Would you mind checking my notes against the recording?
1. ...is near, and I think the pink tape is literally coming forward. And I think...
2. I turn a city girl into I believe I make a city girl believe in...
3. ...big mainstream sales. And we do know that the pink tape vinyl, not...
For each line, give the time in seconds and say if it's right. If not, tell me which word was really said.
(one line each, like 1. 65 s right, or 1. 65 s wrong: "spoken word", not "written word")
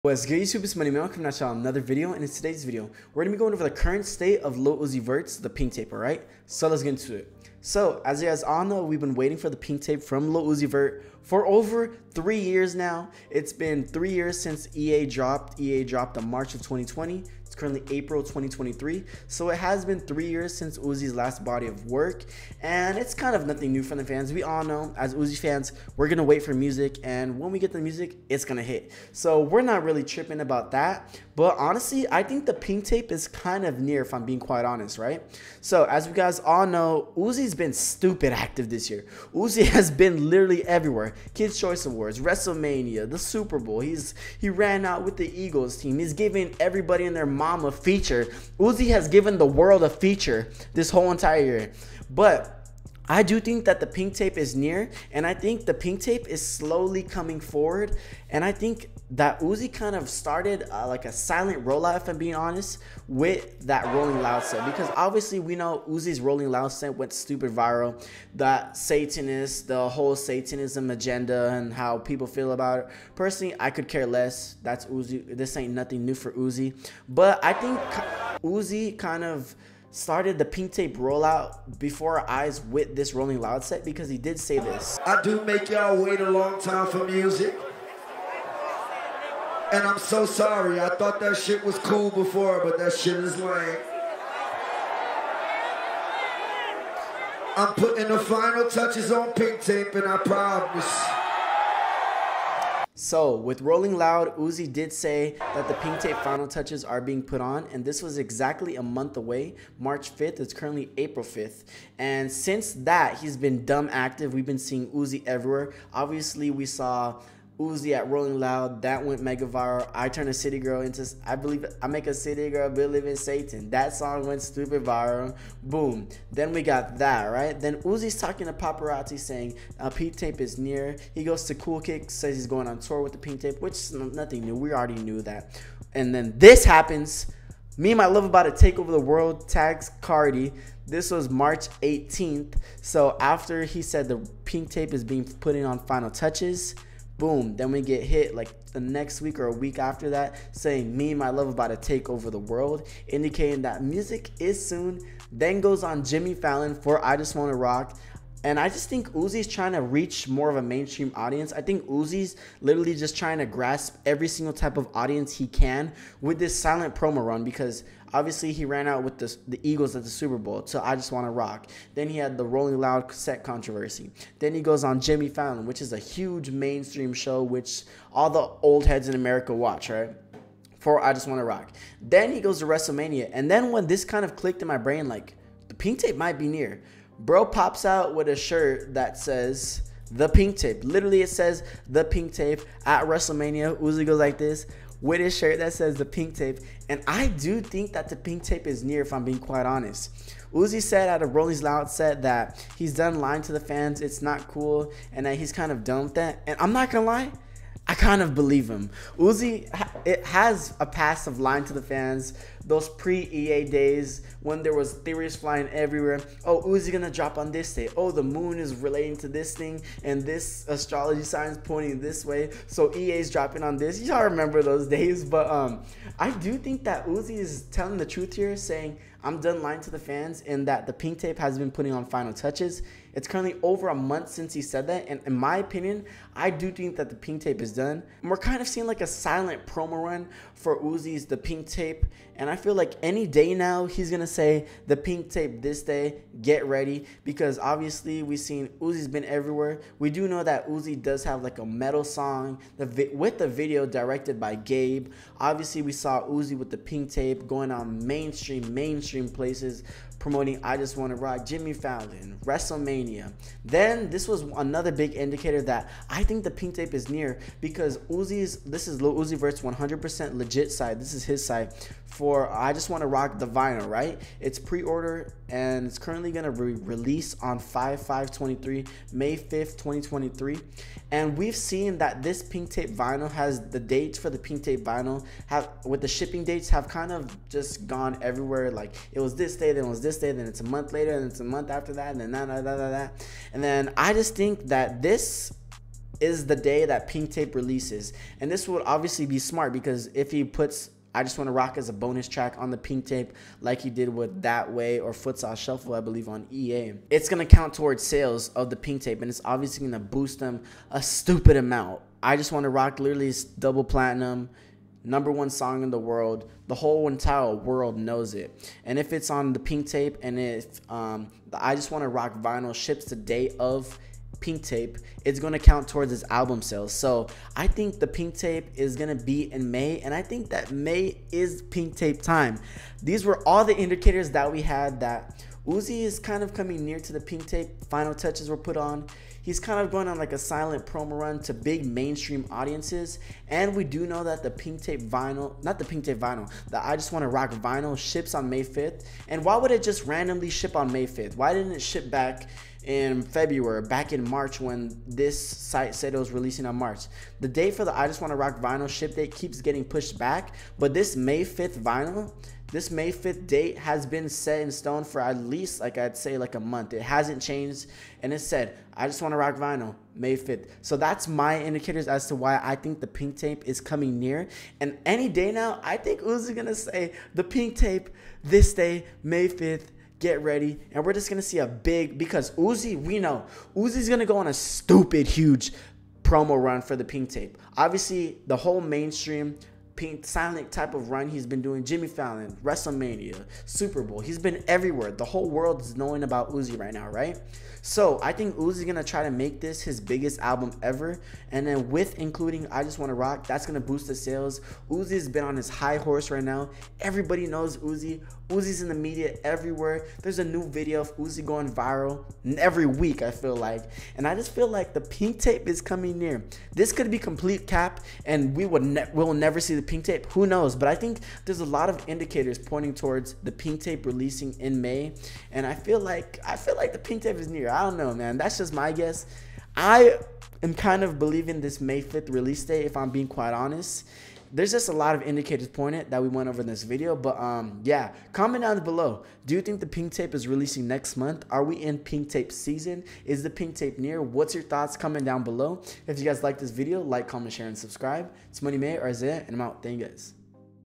1. 54 s wrong: "slowly", not "literally"
2. 119 s right
3. 341 s wrong: "audiences", not "sales".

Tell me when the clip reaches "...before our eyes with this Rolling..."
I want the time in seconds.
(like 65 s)
81 s.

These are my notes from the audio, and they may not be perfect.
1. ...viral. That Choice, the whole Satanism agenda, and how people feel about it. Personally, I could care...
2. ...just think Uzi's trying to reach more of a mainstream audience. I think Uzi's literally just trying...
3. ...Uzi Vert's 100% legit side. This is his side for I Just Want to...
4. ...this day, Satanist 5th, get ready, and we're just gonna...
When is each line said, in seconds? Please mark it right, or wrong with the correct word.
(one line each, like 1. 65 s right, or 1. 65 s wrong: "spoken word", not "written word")
1. 67 s wrong: "Satanist", not "Choice"
2. 158 s right
3. 269 s right
4. 378 s wrong: "May", not "Satanist".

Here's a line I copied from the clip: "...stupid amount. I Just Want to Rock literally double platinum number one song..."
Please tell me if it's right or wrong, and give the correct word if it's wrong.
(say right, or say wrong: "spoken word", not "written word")
right.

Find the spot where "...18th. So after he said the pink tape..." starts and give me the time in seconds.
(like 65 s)
141 s.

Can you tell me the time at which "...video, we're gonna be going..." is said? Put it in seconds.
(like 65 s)
2 s.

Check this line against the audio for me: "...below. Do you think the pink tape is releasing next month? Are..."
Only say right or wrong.
right.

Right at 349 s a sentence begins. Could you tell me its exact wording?
And why would it just randomly ship on May 5th?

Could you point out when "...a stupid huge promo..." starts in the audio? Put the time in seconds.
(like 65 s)
384 s.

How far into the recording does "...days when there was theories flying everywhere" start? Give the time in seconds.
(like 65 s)
213 s.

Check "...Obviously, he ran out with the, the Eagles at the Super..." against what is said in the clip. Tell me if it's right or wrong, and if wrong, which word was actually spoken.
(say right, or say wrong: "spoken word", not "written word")
right.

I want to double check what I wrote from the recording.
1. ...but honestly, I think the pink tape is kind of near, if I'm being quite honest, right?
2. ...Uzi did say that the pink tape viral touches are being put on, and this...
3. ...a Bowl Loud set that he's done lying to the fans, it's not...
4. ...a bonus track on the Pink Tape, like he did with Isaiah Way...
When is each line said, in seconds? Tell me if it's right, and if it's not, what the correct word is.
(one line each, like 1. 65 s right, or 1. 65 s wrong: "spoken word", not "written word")
1. 31 s right
2. 104 s wrong: "final", not "viral"
3. 201 s wrong: "Rolling", not "Bowl"
4. 301 s wrong: "That", not "Isaiah".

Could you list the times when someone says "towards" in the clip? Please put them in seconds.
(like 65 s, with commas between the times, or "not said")
307 s, 325 s, 422 s.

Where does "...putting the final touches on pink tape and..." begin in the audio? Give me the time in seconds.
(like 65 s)
97 s.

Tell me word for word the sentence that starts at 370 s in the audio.
So that's my indicators as to why I think the pink tape is coming near.